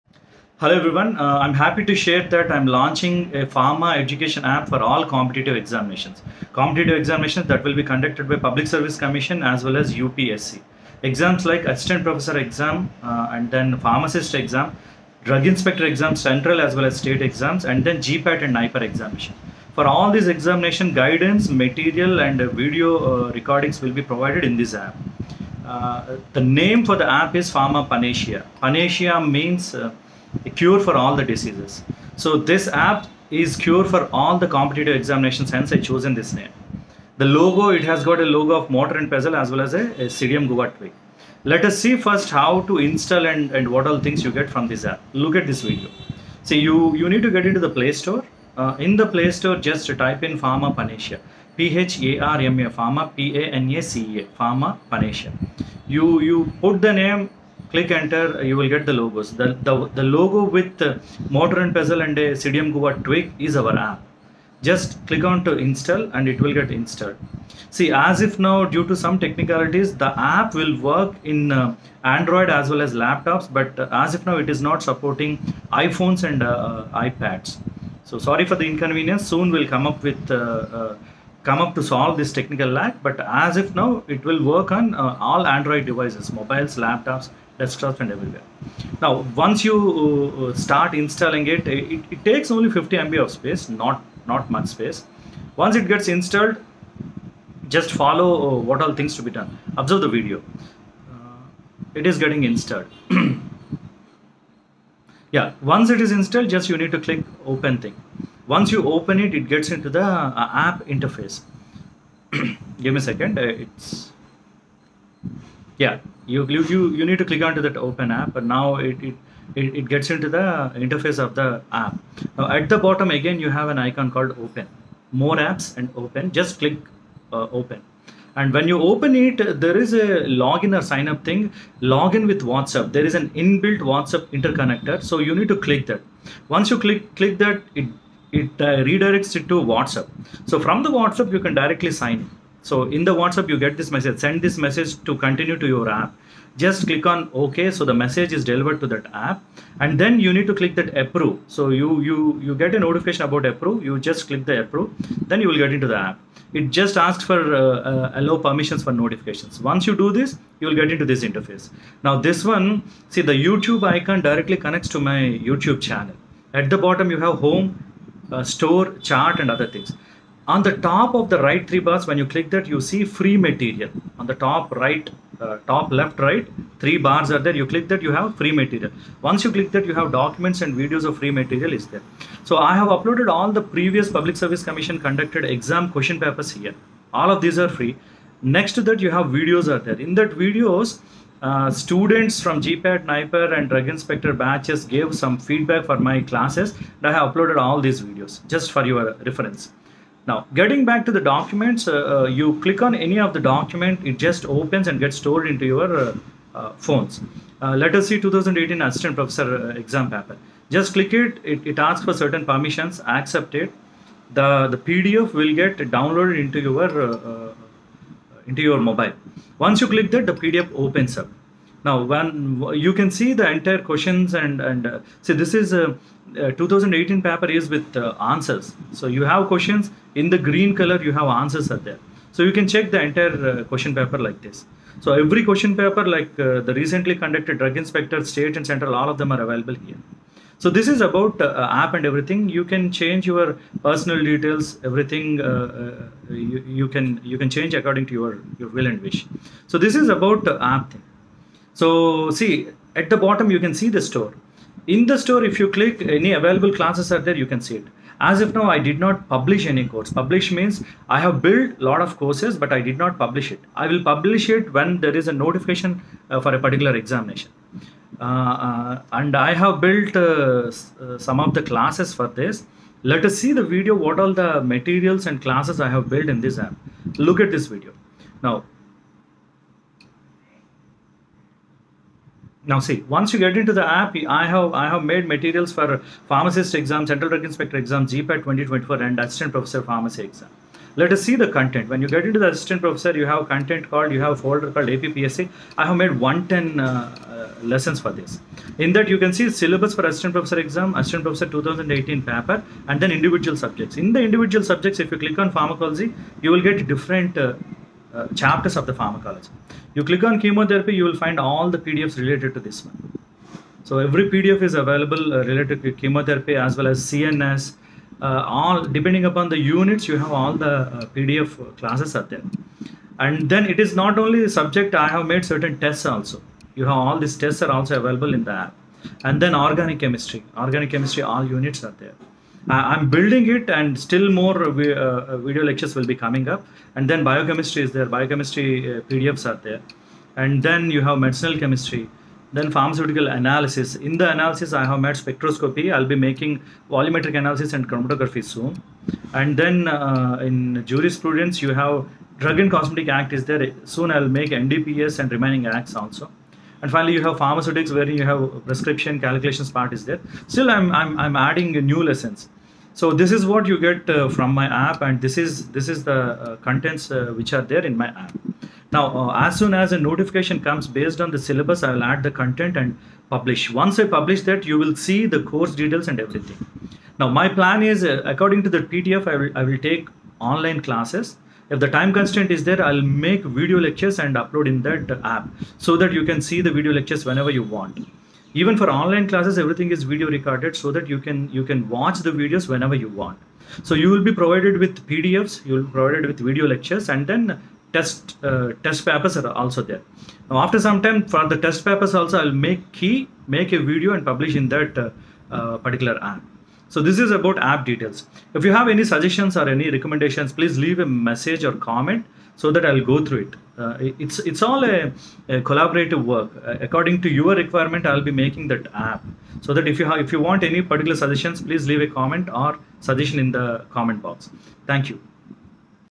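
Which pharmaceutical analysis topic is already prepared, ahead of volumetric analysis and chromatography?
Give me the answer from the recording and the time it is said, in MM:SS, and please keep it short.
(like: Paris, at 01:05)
Spectroscopy, at 05:45.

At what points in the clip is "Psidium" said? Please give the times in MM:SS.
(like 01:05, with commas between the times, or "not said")
00:40, 01:02.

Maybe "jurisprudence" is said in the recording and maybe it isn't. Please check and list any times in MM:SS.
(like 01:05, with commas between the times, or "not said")
05:50.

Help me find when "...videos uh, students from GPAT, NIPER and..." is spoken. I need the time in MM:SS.
03:10.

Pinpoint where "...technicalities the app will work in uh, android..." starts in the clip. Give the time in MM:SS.
01:09.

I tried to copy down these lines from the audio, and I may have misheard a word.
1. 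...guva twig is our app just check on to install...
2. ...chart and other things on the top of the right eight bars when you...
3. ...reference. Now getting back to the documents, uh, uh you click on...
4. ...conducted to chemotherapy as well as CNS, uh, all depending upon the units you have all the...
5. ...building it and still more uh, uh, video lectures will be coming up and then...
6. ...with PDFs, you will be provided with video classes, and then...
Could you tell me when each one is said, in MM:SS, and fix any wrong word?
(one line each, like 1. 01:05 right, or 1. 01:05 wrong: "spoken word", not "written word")
1. 01:02 wrong: "click", not "check"
2. 02:49 wrong: "three", not "eight"
3. 03:19 right
4. 05:15 wrong: "related", not "conducted"
5. 05:33 right
6. 06:34 wrong: "lectures", not "classes".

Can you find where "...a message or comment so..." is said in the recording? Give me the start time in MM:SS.
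06:50.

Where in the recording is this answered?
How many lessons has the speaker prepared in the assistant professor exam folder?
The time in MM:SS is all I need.
04:56.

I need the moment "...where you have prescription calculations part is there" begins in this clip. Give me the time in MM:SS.
05:57.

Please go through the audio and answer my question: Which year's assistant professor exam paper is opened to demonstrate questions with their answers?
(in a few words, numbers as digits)
2018.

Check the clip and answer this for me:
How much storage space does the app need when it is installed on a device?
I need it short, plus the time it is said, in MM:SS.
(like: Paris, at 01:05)
50 MB, at 01:32.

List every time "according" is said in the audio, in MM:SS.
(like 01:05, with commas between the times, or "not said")
04:07, 06:18, 06:56.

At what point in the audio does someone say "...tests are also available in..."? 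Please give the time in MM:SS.
05:27.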